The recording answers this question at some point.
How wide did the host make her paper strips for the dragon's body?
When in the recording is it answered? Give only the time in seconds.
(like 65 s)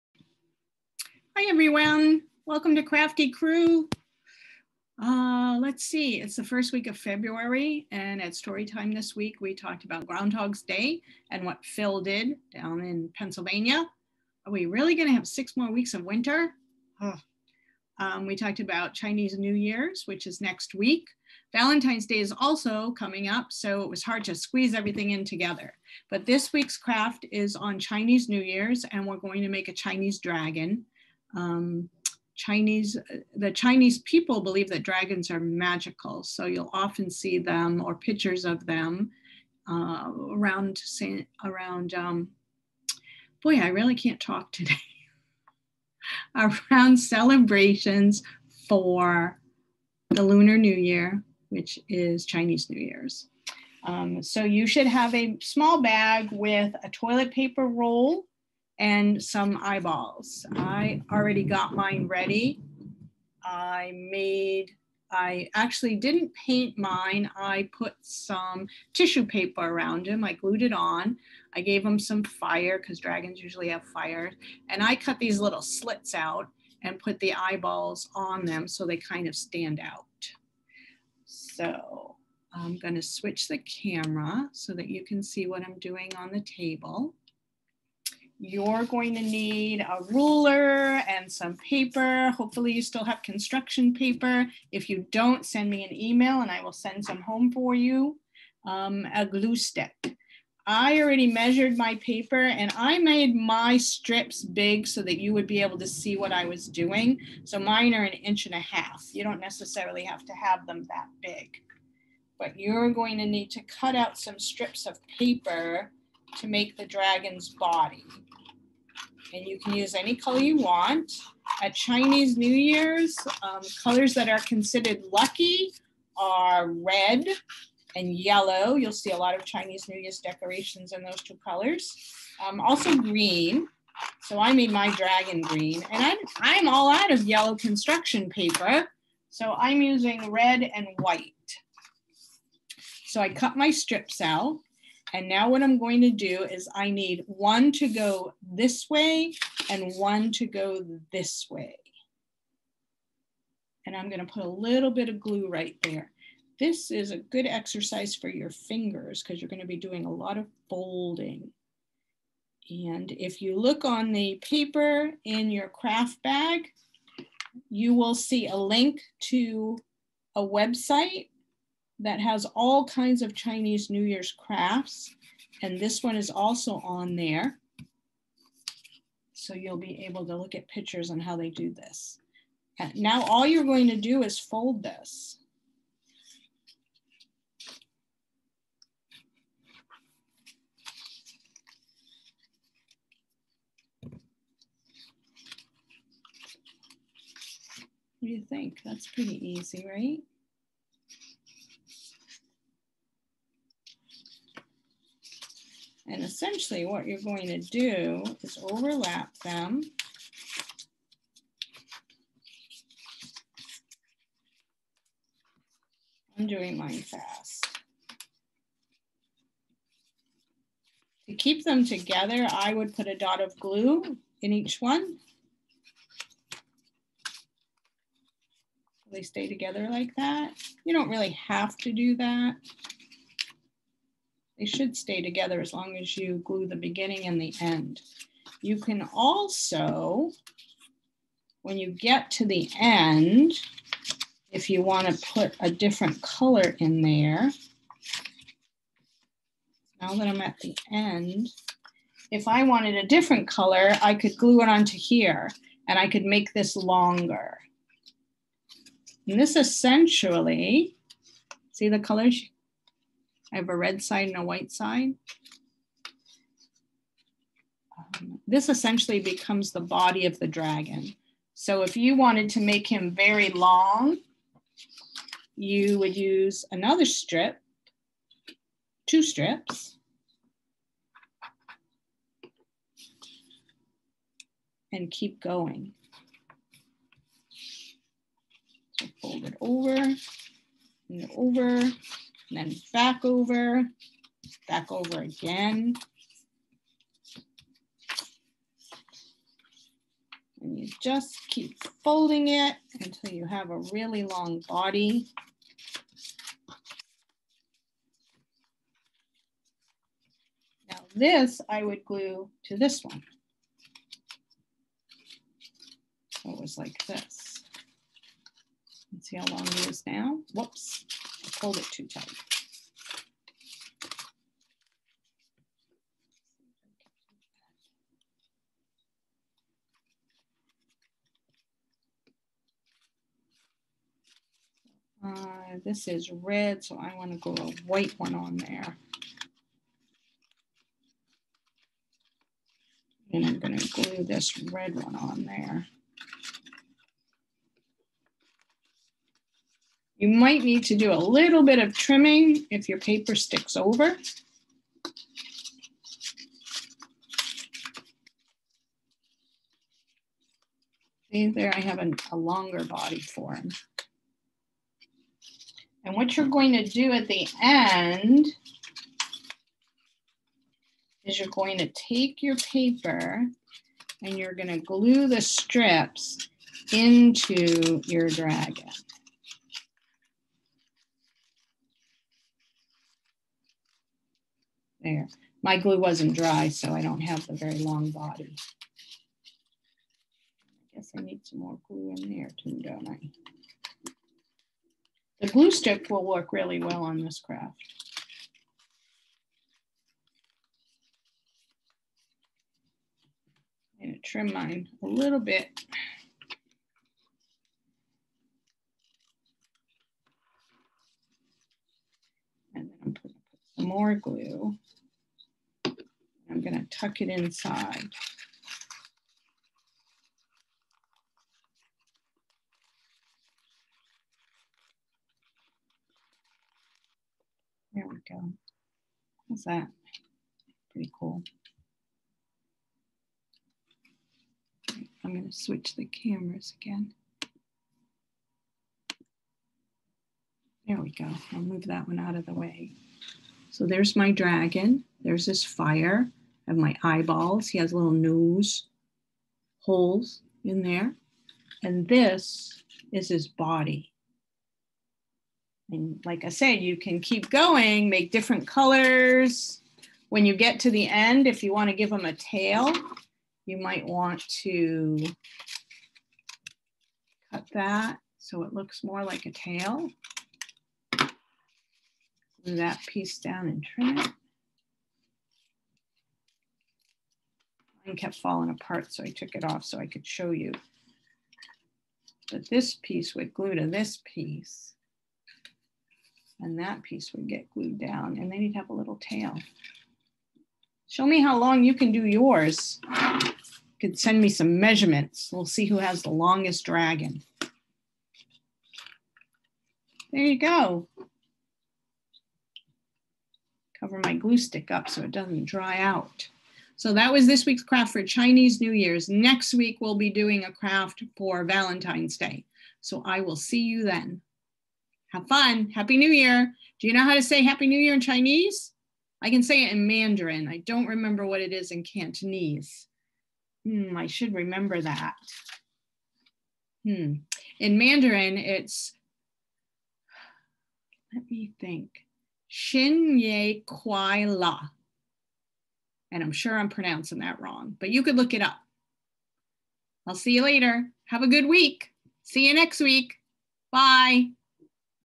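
108 s.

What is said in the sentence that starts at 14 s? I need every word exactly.
Are we really going to have six more weeks of winter?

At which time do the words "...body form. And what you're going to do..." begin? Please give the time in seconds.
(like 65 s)
362 s.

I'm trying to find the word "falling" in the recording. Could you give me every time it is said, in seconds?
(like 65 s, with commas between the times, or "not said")
478 s.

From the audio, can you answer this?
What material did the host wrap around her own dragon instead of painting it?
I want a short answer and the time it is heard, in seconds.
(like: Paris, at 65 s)
tissue paper, at 68 s.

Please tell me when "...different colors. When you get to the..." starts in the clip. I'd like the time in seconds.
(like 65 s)
458 s.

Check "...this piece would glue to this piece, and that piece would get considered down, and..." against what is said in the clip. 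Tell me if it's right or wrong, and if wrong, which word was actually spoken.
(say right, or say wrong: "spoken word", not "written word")
wrong: "glued", not "considered".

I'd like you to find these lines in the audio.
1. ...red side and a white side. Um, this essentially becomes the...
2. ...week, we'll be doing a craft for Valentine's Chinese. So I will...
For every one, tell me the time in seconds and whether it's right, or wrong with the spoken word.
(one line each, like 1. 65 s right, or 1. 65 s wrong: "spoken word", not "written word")
1. 263 s right
2. 509 s wrong: "Day", not "Chinese".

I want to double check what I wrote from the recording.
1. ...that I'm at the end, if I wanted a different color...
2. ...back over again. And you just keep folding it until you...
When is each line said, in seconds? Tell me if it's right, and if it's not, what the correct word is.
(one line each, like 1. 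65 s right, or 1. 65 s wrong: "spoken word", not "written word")
1. 250 s right
2. 294 s right.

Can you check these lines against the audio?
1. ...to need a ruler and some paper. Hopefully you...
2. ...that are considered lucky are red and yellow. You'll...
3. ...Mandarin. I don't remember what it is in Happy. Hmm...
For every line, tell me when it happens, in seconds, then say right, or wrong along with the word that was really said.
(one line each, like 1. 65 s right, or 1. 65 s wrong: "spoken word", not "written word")
1. 89 s right
2. 124 s right
3. 520 s wrong: "Cantonese", not "Happy".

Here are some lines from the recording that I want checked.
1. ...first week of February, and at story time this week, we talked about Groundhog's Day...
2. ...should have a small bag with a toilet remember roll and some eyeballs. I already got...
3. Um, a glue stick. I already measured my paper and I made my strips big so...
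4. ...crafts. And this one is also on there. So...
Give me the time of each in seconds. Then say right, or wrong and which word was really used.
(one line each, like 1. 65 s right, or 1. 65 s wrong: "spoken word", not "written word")
1. 6 s right
2. 54 s wrong: "paper", not "remember"
3. 98 s right
4. 174 s right.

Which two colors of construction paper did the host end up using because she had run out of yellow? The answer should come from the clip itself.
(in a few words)
red and white.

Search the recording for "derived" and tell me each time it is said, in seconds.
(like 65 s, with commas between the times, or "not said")
not said.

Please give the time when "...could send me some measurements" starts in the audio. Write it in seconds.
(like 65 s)
493 s.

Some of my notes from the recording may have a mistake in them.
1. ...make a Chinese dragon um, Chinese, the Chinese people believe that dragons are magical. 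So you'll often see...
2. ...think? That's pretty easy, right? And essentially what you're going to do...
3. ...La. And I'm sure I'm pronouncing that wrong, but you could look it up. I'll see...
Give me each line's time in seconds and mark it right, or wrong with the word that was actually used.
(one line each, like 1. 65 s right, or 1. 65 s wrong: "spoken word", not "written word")
1. 29 s right
2. 198 s right
3. 534 s right.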